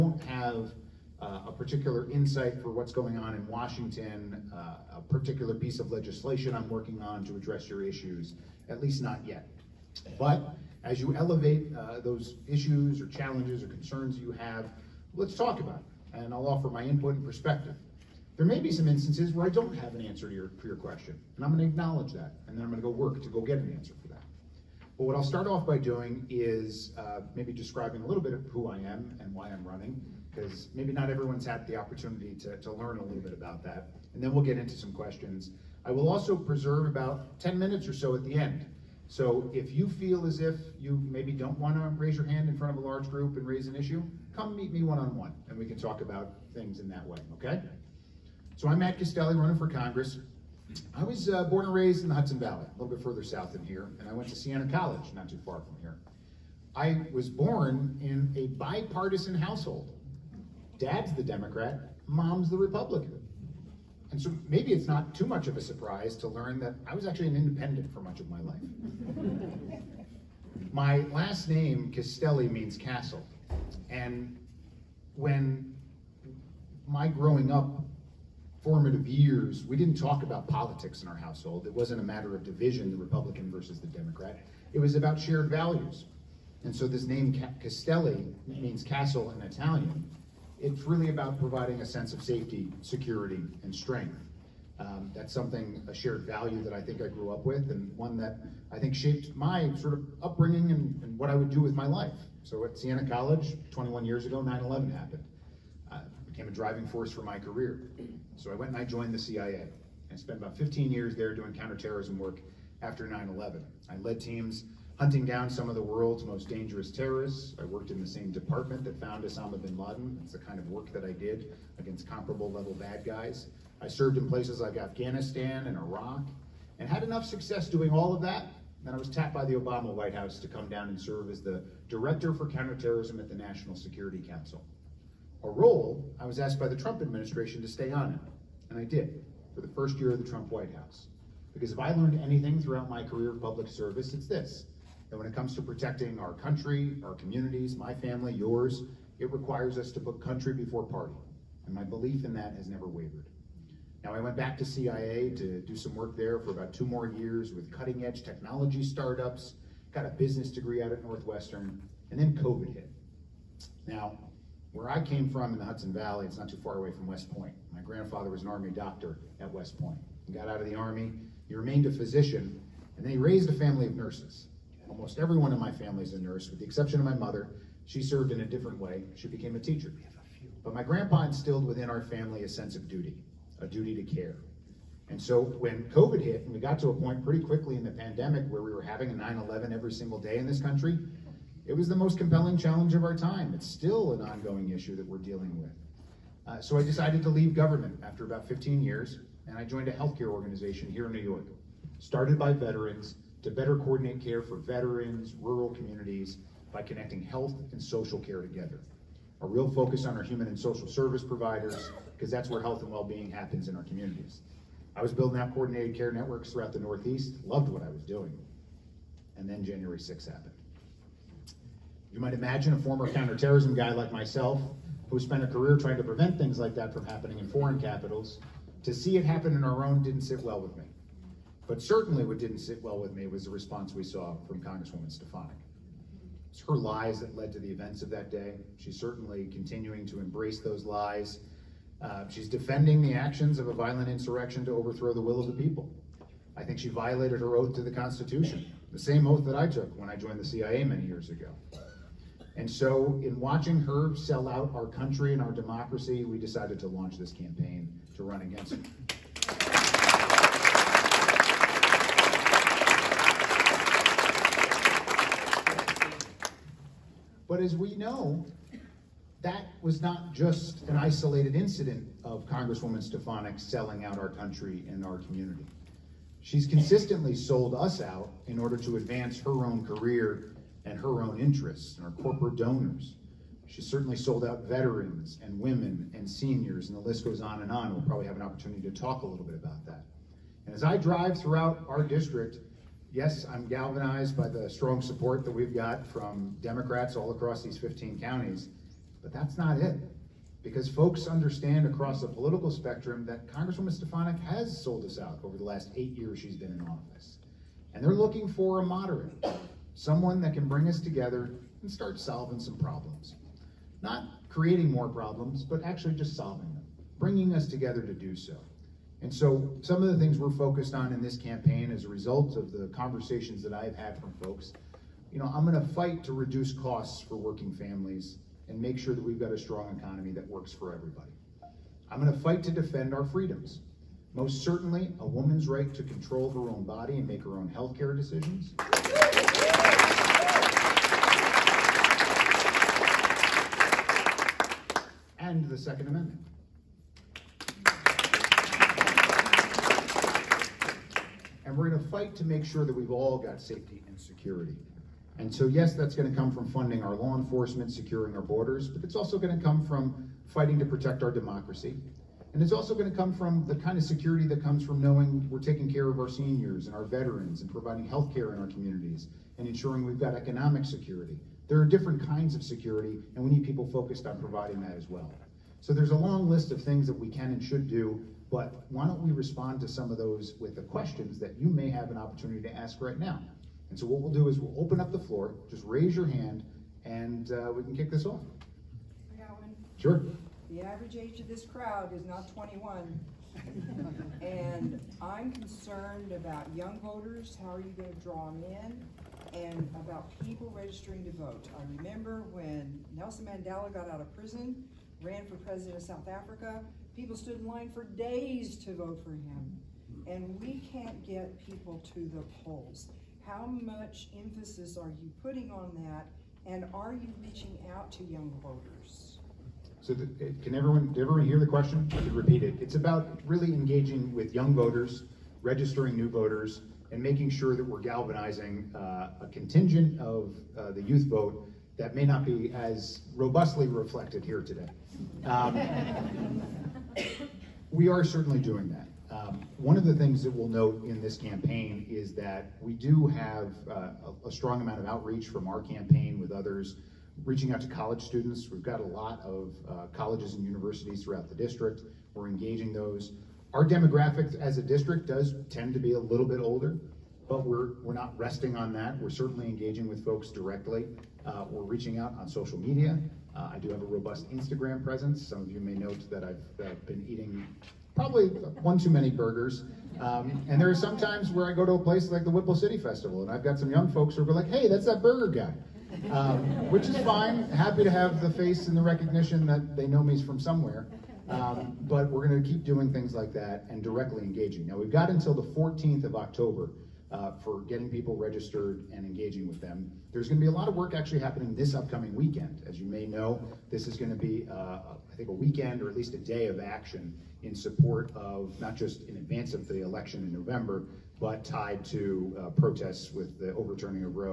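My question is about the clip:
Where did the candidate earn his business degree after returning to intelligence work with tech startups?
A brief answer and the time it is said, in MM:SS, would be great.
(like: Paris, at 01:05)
Northwestern, at 02:41.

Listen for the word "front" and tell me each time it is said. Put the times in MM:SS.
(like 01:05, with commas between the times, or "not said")
00:42.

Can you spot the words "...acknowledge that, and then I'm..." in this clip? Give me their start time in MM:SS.
00:21.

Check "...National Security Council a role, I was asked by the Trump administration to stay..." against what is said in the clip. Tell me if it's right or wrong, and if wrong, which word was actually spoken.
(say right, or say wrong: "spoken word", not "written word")
right.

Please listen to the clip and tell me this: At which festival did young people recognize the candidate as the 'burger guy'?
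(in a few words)
Whipple City Festival.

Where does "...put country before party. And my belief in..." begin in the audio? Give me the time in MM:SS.
02:29.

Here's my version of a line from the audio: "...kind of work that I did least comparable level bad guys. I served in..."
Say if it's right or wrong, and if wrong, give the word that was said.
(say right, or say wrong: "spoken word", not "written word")
wrong: "against", not "least".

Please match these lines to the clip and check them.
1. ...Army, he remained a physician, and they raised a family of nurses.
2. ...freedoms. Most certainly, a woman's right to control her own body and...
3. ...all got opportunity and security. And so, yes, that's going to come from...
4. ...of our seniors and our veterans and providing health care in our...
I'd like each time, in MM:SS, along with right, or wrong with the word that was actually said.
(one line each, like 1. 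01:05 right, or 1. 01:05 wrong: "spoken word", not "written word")
1. 02:50 right
2. 05:33 right
3. 05:53 wrong: "safety", not "opportunity"
4. 06:06 right.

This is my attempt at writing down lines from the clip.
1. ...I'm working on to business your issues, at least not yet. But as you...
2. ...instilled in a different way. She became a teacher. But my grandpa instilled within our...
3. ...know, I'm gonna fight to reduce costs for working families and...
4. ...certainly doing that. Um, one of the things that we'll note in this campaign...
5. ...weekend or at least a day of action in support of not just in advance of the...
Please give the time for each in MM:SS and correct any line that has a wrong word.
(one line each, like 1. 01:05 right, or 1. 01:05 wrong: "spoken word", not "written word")
1. 00:06 wrong: "address", not "business"
2. 02:58 wrong: "served", not "instilled"
3. 05:25 right
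4. 07:18 right
5. 08:15 right.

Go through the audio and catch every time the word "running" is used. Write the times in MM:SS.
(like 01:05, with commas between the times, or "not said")
00:29, 00:49.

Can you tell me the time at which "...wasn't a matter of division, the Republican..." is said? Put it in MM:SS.
01:21.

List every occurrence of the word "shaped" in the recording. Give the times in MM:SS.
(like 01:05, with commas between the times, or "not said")
01:38.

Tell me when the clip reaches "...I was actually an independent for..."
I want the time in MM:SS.
01:06.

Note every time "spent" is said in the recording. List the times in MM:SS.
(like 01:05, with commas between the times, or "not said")
01:50, 03:45.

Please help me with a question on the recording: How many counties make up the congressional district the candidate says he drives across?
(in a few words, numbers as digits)
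15.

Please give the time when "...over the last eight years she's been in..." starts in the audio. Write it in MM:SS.
05:05.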